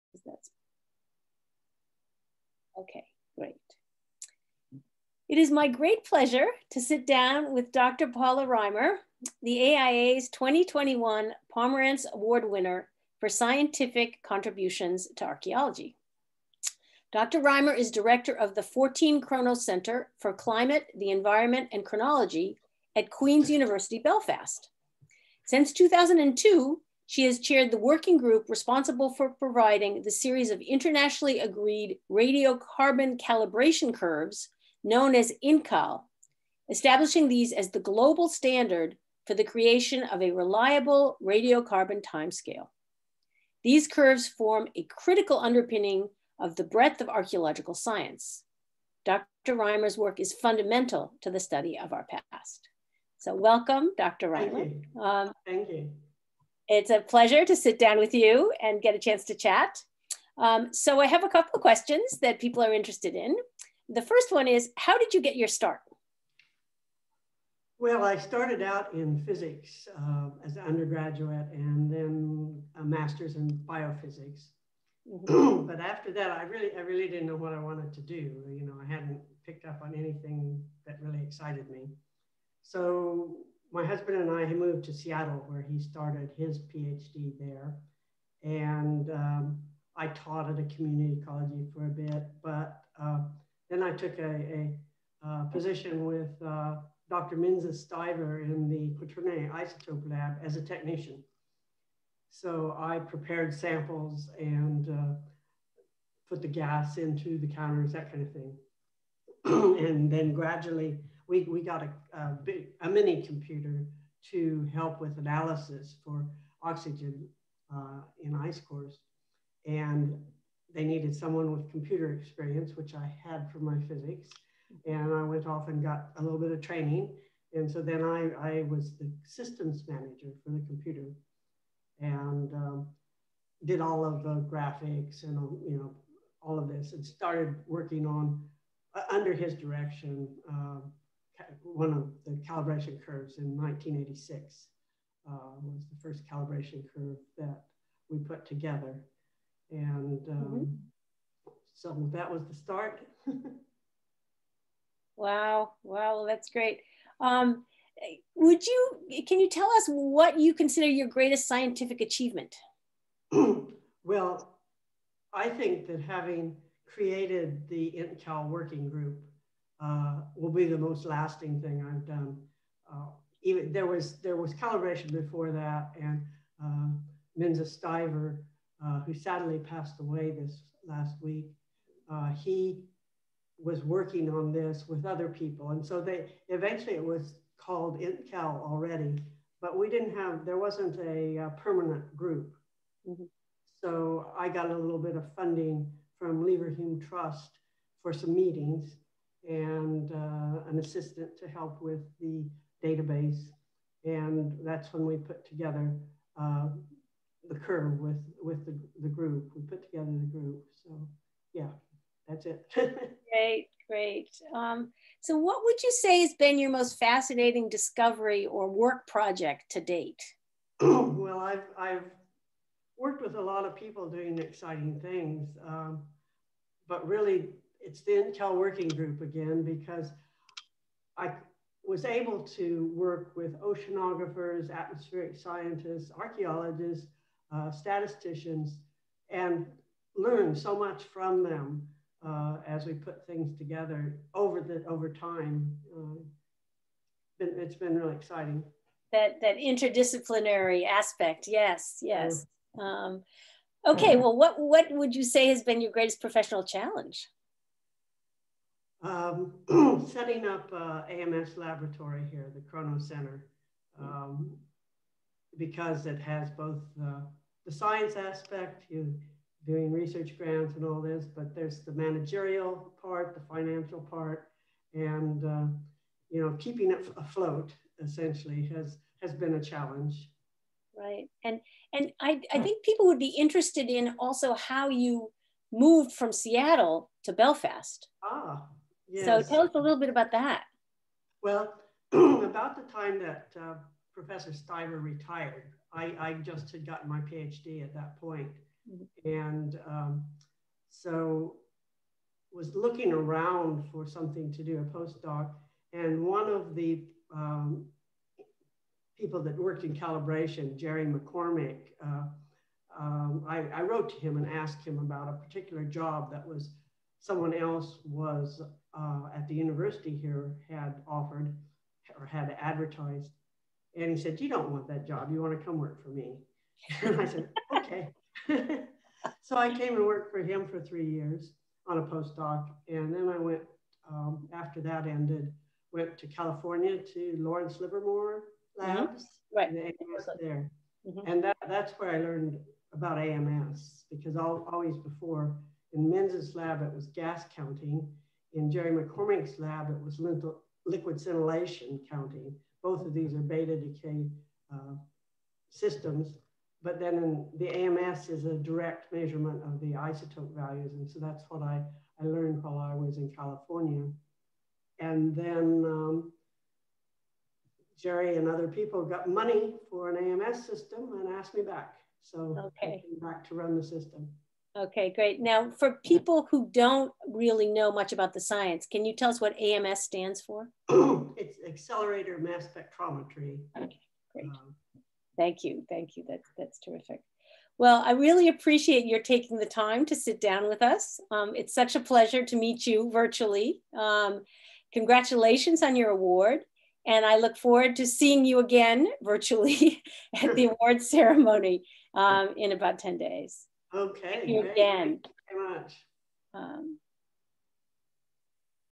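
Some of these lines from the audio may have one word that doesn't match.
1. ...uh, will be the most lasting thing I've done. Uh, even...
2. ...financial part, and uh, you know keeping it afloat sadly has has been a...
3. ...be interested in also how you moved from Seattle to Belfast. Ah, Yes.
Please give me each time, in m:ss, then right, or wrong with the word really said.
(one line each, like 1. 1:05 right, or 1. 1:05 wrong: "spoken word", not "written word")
1. 2:49 right
2. 4:33 wrong: "essentially", not "sadly"
3. 4:43 right.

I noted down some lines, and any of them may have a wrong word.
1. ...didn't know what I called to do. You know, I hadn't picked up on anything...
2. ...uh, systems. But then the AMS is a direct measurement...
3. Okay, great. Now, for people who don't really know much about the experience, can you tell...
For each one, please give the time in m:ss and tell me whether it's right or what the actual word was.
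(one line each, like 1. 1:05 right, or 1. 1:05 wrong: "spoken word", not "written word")
1. 1:17 wrong: "wanted", not "called"
2. 5:54 right
3. 6:14 wrong: "science", not "experience".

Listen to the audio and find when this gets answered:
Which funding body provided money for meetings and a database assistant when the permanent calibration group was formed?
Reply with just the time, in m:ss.
3:16.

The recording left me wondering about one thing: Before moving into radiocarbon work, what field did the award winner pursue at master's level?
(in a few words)
biophysics.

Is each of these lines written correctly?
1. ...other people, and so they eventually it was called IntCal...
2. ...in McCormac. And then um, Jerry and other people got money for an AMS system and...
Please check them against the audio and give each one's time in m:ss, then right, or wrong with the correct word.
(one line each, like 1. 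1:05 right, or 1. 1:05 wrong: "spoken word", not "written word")
1. 3:05 right
2. 6:03 wrong: "California", not "McCormac".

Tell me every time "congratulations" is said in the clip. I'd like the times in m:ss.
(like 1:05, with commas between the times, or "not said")
6:34.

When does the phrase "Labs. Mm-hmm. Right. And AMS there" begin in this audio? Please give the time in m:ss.
5:38.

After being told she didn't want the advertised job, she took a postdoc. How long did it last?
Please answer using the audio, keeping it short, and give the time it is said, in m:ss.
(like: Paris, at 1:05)
3 years, at 5:30.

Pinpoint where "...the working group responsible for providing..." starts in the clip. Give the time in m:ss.
0:27.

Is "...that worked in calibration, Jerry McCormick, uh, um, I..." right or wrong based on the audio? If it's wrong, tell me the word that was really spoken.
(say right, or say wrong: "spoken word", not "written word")
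right.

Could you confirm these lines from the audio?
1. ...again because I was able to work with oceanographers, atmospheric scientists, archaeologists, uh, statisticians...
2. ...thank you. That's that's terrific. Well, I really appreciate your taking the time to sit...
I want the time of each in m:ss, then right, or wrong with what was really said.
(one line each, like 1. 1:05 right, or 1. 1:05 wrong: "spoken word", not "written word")
1. 3:49 right
2. 6:25 right.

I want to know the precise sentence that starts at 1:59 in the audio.
And they needed someone with computer experience, which I had for my physics.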